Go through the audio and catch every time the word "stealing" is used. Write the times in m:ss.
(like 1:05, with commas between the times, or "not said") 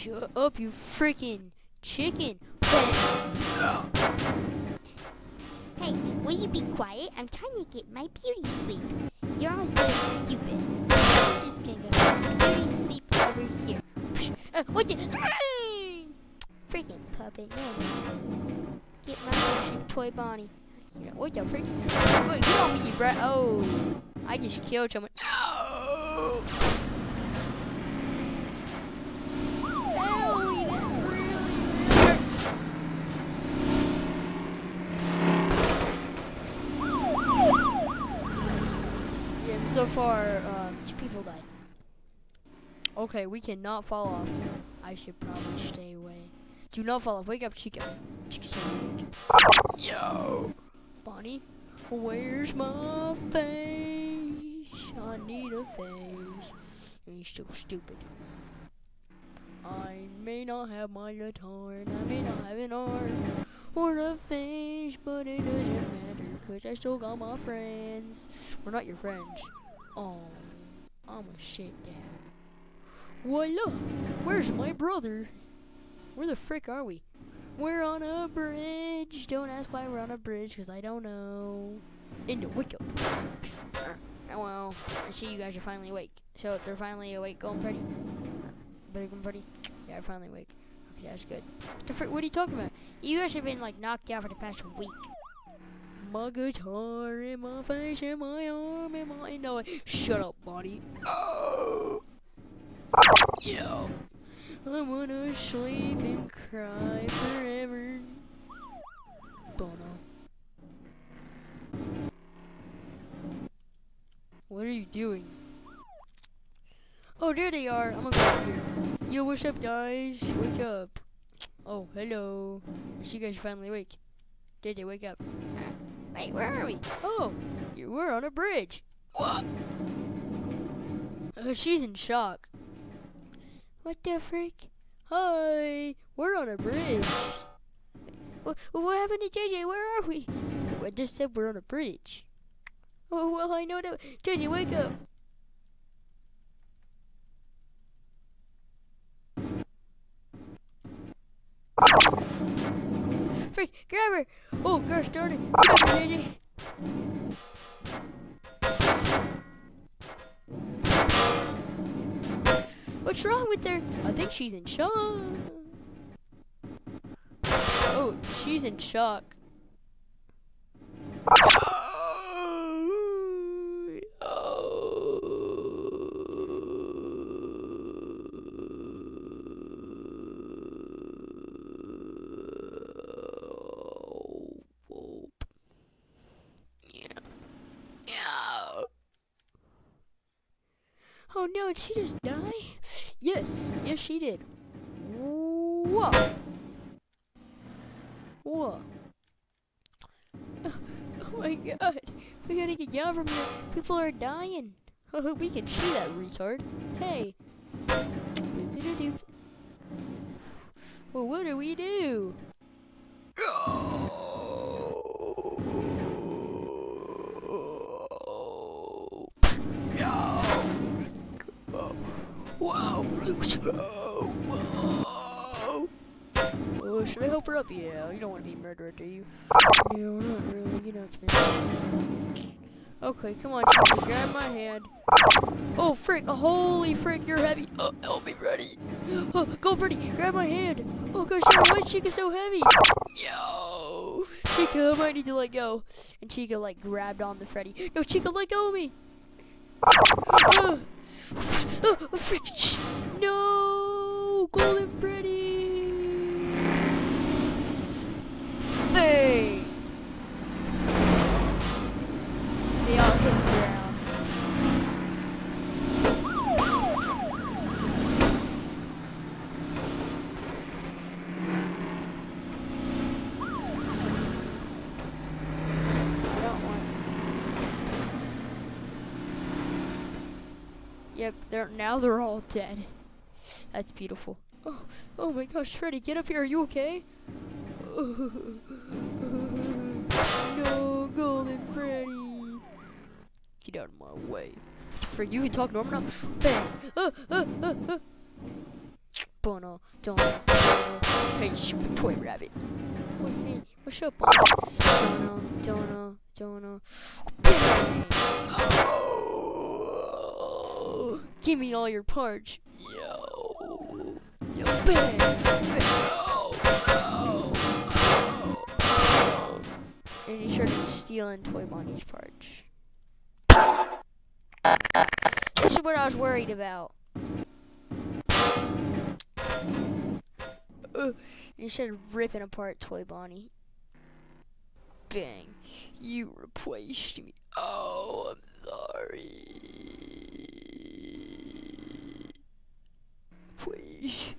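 5:20.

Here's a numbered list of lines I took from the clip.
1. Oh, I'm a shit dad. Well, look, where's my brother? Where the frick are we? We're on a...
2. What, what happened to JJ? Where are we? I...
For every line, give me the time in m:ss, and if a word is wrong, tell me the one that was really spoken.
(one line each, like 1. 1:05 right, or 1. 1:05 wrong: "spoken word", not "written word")
1. 1:09 right
2. 2:18 right.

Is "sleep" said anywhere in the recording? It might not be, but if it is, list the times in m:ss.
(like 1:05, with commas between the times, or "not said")
0:08, 0:12, 1:45.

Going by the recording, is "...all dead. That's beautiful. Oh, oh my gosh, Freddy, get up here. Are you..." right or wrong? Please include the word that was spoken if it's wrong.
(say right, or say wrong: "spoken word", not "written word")
right.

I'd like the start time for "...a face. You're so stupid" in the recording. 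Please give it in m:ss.
0:55.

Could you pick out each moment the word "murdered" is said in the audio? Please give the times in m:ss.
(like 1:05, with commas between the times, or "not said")
3:48.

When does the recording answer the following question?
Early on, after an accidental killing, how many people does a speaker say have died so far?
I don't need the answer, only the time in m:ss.
0:40.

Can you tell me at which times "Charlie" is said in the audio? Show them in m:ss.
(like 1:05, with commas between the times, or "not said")
3:53.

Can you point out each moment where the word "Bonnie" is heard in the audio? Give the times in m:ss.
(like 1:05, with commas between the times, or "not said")
0:20, 0:51, 5:21, 5:33.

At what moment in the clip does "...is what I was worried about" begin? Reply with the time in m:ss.
5:25.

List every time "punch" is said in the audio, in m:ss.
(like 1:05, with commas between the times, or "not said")
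5:12, 5:22.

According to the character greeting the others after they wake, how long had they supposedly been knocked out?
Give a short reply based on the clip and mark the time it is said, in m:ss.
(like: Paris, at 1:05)
The past week, at 1:34.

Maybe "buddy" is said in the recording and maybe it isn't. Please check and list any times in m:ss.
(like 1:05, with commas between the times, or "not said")
1:40.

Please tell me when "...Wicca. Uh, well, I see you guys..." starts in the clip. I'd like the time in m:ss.
1:22.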